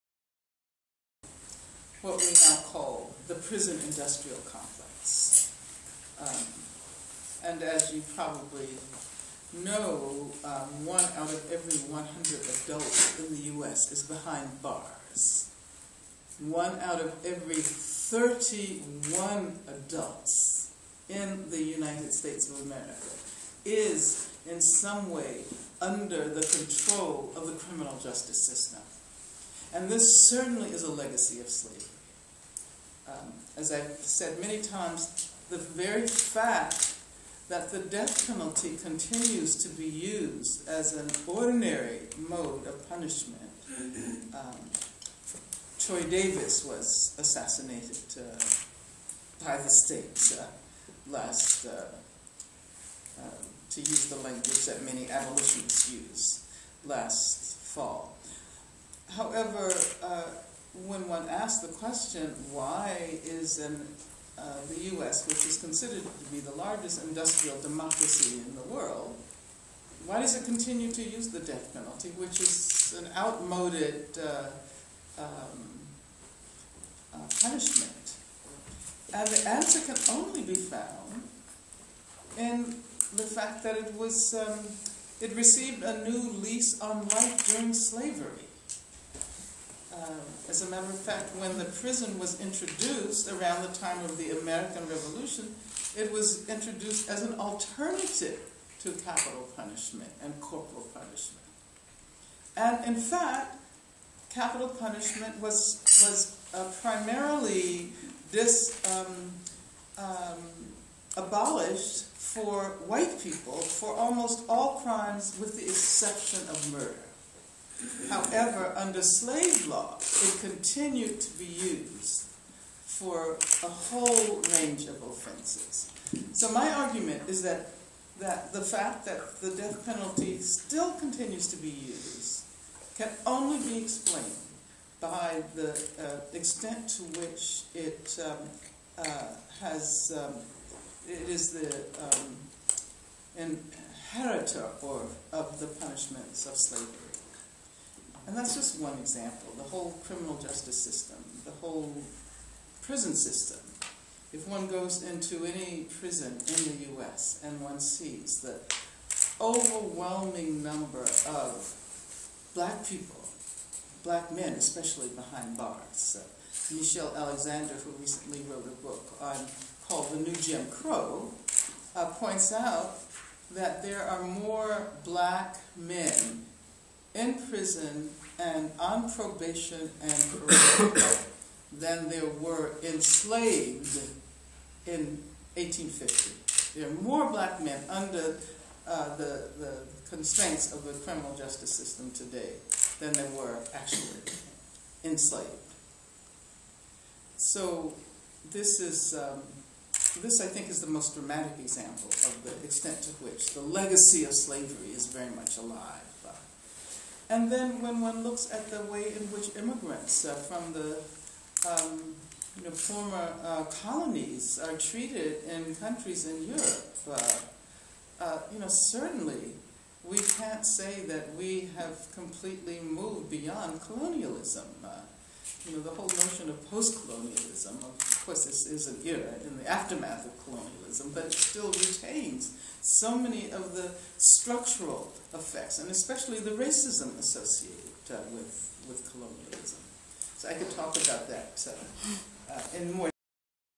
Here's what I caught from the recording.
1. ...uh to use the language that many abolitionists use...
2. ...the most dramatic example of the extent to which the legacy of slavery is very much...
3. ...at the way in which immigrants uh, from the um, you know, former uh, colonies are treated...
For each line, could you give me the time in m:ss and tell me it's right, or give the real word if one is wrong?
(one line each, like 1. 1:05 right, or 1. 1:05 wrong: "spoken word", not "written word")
1. 0:53 right
2. 3:20 right
3. 3:28 right.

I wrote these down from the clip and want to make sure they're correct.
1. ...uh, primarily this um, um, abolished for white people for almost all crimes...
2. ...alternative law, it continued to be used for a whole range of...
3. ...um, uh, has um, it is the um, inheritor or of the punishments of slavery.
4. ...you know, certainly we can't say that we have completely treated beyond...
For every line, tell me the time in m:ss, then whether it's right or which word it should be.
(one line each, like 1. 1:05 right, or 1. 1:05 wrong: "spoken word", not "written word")
1. 1:46 right
2. 1:59 wrong: "slave", not "alternative"
3. 2:18 right
4. 3:38 wrong: "moved", not "treated".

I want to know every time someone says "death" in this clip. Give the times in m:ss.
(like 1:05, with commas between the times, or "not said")
0:37, 1:11, 2:09.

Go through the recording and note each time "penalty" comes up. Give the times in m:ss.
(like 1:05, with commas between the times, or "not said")
0:38, 1:11, 2:09.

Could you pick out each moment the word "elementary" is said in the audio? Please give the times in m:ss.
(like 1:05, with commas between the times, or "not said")
not said.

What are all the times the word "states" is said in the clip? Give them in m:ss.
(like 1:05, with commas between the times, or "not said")
0:22, 0:49.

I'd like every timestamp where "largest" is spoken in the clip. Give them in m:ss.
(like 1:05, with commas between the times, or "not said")
1:06.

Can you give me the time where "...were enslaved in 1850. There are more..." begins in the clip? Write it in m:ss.
3:02.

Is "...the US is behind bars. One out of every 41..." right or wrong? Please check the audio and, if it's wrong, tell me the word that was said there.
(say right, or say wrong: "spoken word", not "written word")
wrong: "31", not "41".